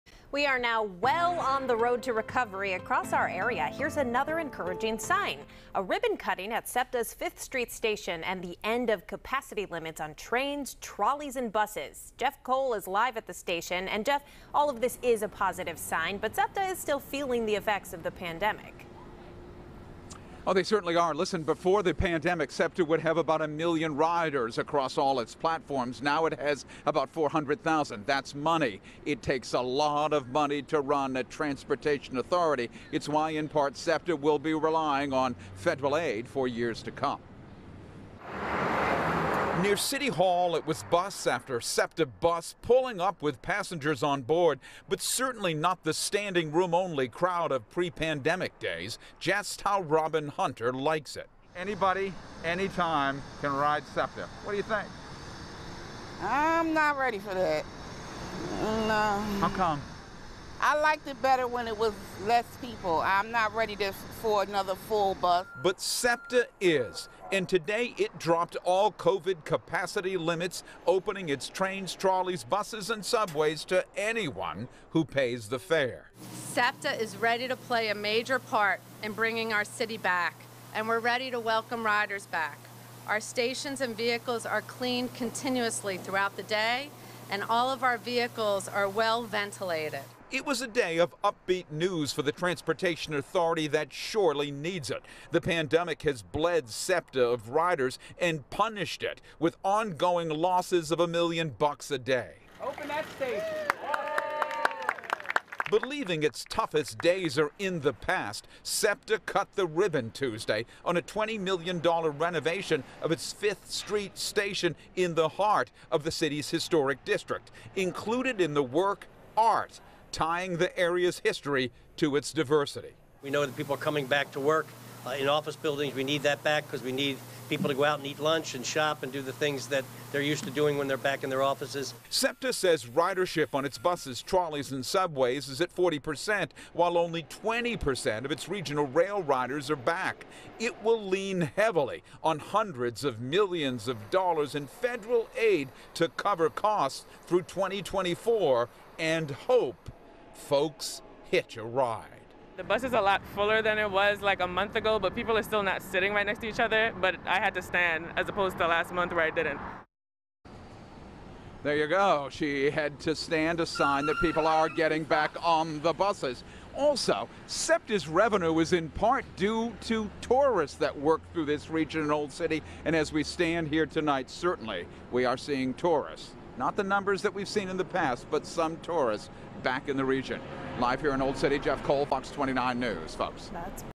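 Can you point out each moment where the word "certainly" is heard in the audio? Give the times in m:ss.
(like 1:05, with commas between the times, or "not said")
0:20, 0:45, 2:54.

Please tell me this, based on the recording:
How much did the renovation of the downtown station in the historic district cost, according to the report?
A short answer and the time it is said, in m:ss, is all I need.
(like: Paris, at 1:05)
$20 million, at 1:51.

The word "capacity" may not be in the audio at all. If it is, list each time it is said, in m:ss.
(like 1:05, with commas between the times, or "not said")
0:09, 1:09.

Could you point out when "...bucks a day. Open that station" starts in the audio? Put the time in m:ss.
1:41.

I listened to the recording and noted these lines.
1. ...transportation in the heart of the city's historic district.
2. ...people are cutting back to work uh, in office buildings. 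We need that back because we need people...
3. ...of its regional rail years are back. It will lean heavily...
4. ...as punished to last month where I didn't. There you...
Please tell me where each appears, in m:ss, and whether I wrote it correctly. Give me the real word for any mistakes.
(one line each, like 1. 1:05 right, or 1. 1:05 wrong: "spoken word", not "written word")
1. 1:54 wrong: "station", not "transportation"
2. 2:03 wrong: "coming", not "cutting"
3. 2:18 wrong: "riders", not "years"
4. 2:38 wrong: "opposed", not "punished".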